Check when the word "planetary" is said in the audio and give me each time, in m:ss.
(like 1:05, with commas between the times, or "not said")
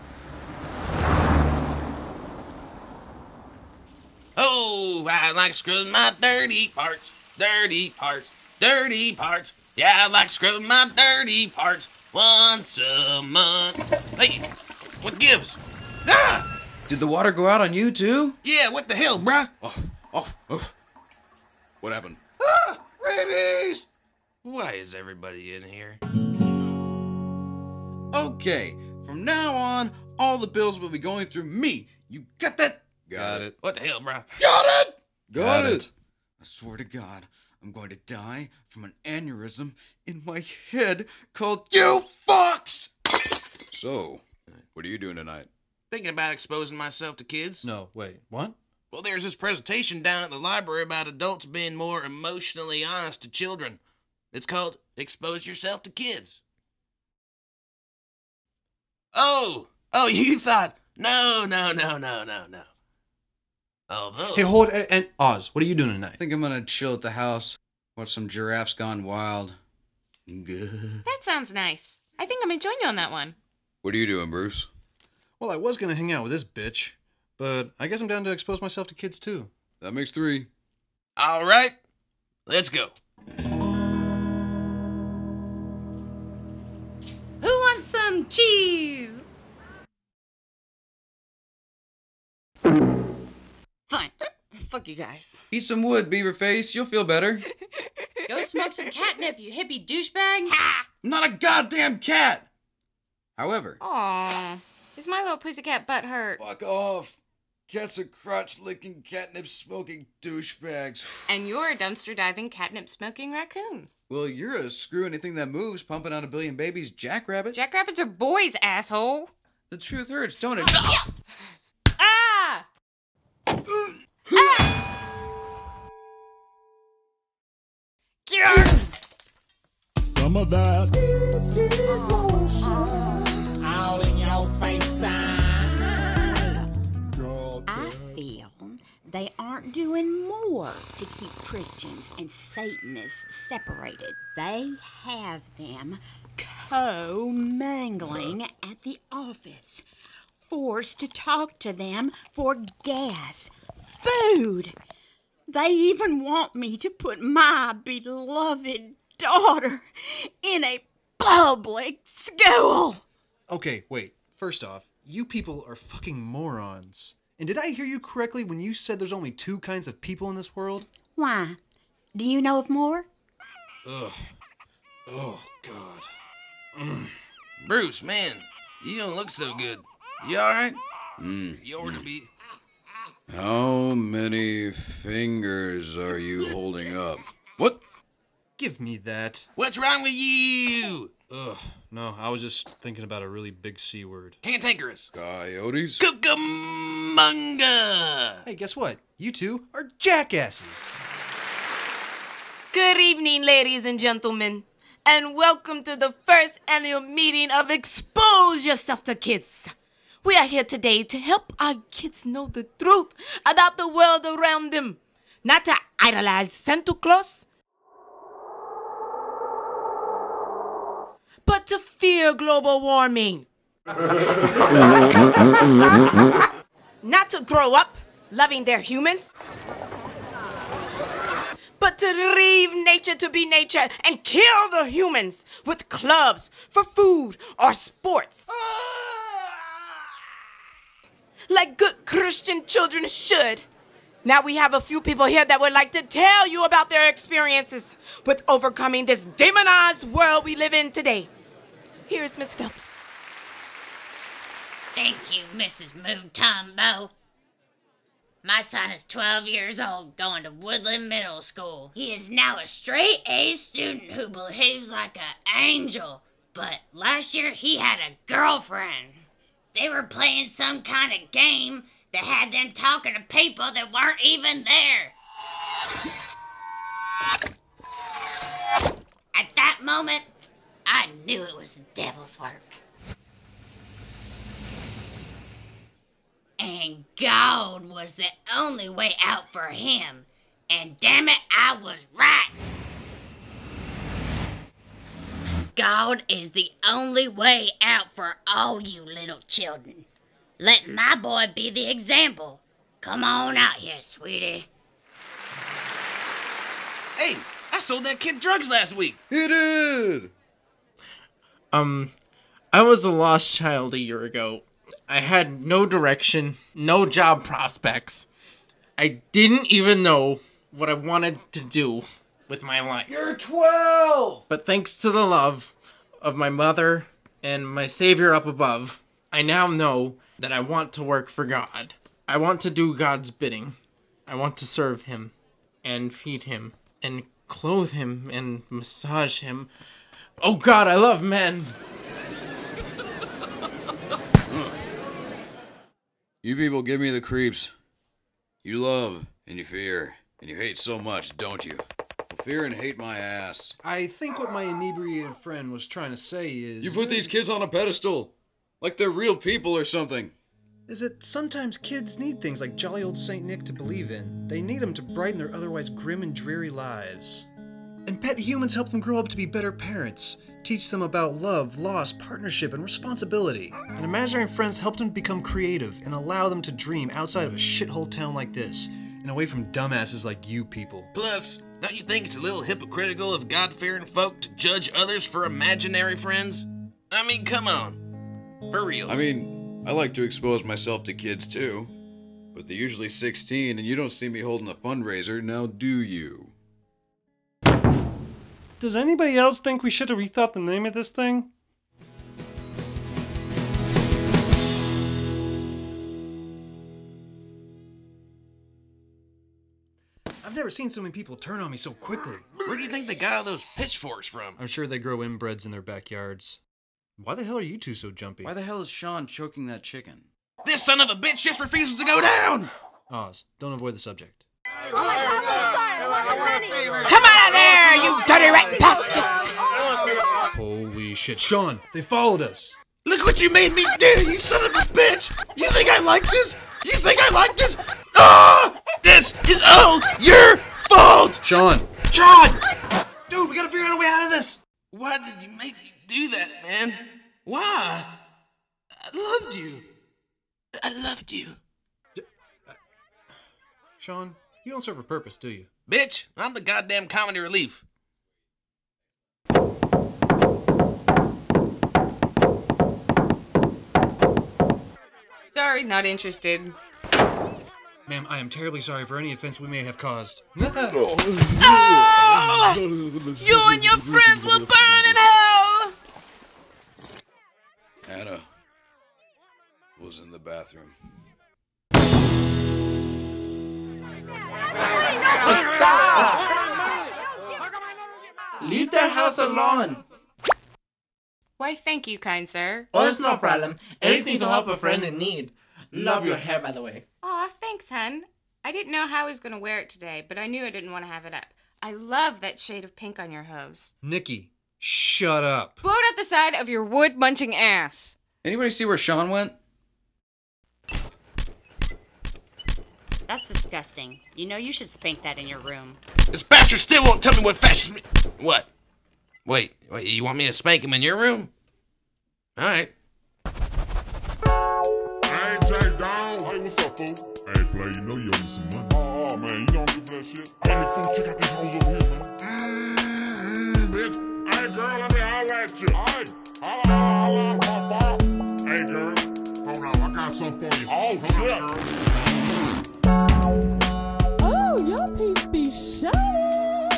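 not said.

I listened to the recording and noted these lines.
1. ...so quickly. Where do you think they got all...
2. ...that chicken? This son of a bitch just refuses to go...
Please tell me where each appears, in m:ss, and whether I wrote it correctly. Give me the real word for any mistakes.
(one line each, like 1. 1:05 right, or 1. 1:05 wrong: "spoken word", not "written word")
1. 6:51 right
2. 6:59 right.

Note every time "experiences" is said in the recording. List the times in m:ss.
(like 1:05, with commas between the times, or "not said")
4:07.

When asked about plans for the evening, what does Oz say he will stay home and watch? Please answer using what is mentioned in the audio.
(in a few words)
Giraffes Gone Wild.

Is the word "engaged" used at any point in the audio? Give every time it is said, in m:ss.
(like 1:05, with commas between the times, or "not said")
not said.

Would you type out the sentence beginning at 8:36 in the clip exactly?
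This bastard still won't tell me what fashion...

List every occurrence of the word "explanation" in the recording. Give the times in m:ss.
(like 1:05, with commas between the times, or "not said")
not said.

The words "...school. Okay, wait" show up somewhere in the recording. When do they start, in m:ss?
2:42.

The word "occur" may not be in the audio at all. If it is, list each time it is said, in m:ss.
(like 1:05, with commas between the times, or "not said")
not said.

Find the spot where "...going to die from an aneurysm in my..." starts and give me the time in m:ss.
0:37.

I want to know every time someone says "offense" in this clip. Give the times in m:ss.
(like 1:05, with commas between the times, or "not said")
7:49.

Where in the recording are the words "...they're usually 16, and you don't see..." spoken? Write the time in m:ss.
6:32.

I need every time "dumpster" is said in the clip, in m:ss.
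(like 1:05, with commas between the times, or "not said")
1:51.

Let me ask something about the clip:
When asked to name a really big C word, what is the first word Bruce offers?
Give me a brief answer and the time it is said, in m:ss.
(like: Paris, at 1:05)
Cantankerous, at 3:14.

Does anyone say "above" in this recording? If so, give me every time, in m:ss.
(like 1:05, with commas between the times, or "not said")
5:28.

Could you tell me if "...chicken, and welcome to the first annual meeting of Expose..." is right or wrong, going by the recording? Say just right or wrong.
wrong.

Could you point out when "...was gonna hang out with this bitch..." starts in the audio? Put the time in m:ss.
1:15.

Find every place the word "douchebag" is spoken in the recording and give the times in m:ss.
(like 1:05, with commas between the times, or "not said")
1:39, 1:50.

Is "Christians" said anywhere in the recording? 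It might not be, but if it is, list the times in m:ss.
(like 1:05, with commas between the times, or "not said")
2:21, 4:02.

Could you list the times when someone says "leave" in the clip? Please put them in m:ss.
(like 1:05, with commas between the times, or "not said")
3:52, 8:08.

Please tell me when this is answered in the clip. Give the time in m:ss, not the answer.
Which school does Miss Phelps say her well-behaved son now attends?
4:20.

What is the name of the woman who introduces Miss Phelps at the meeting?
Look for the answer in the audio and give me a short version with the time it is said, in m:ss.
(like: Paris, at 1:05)
Mrs. Mutombo, at 4:15.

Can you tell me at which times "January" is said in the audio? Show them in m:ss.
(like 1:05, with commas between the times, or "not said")
not said.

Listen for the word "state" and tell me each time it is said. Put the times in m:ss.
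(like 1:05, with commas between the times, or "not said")
not said.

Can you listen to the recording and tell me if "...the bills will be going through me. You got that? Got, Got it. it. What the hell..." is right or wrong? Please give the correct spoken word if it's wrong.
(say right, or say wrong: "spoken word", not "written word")
right.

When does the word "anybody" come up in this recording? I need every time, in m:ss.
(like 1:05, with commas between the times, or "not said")
6:38, 8:28.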